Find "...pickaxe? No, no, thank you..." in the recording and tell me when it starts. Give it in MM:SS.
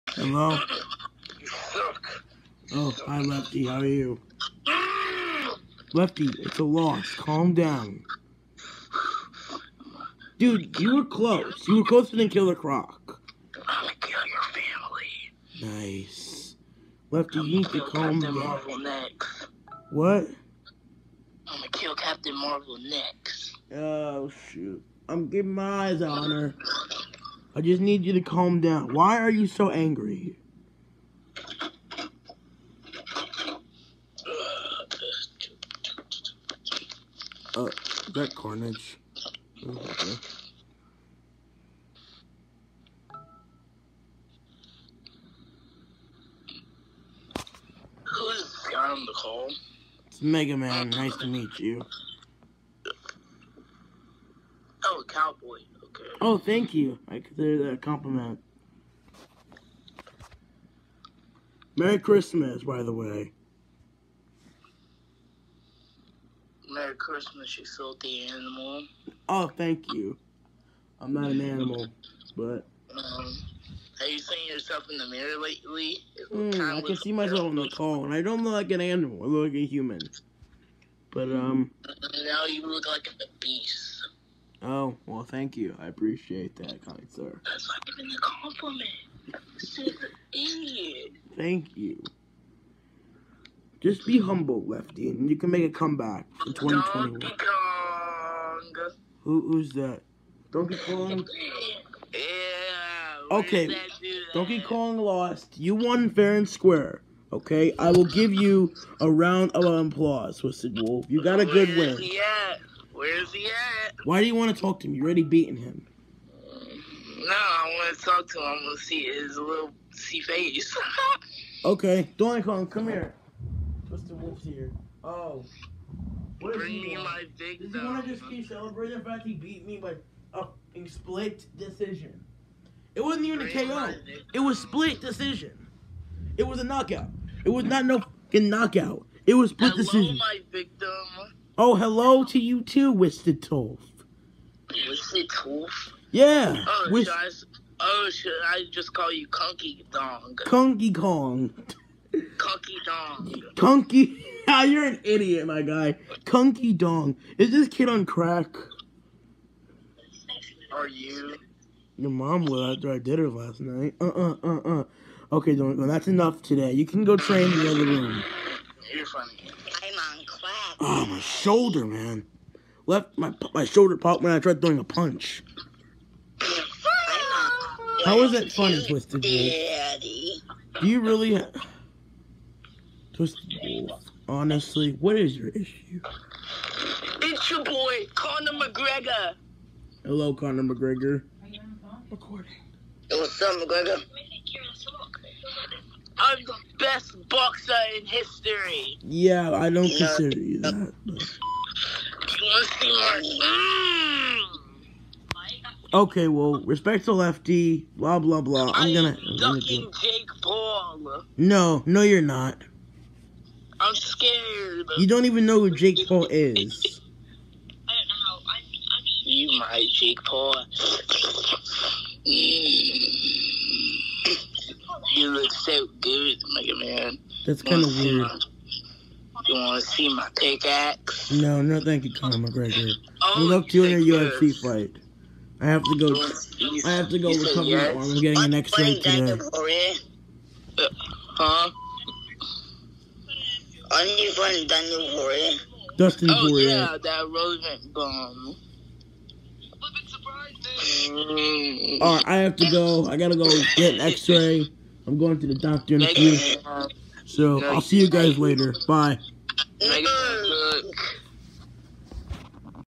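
03:50.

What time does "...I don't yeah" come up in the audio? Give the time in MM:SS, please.
03:19.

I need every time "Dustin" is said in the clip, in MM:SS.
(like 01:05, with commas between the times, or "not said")
04:05.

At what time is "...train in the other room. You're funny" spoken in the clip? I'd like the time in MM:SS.
02:47.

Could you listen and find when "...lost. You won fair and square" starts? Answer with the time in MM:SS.
01:44.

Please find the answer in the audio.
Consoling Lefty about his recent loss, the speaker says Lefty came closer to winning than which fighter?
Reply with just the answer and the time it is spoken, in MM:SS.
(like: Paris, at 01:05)
Killer Croc, at 00:12.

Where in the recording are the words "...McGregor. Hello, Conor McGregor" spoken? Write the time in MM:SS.
03:08.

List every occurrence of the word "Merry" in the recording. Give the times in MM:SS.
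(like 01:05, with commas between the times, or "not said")
01:01, 01:06.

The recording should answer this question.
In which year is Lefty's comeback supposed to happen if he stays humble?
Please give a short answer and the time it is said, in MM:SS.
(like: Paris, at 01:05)
2021, at 01:36.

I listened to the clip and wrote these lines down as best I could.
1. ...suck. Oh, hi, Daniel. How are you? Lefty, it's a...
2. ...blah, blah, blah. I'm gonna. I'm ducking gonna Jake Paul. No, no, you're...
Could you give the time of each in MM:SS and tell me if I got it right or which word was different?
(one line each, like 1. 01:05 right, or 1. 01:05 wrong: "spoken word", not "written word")
1. 00:01 wrong: "Lefty", not "Daniel"
2. 03:27 right.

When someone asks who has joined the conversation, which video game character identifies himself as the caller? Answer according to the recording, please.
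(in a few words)
Mega Man.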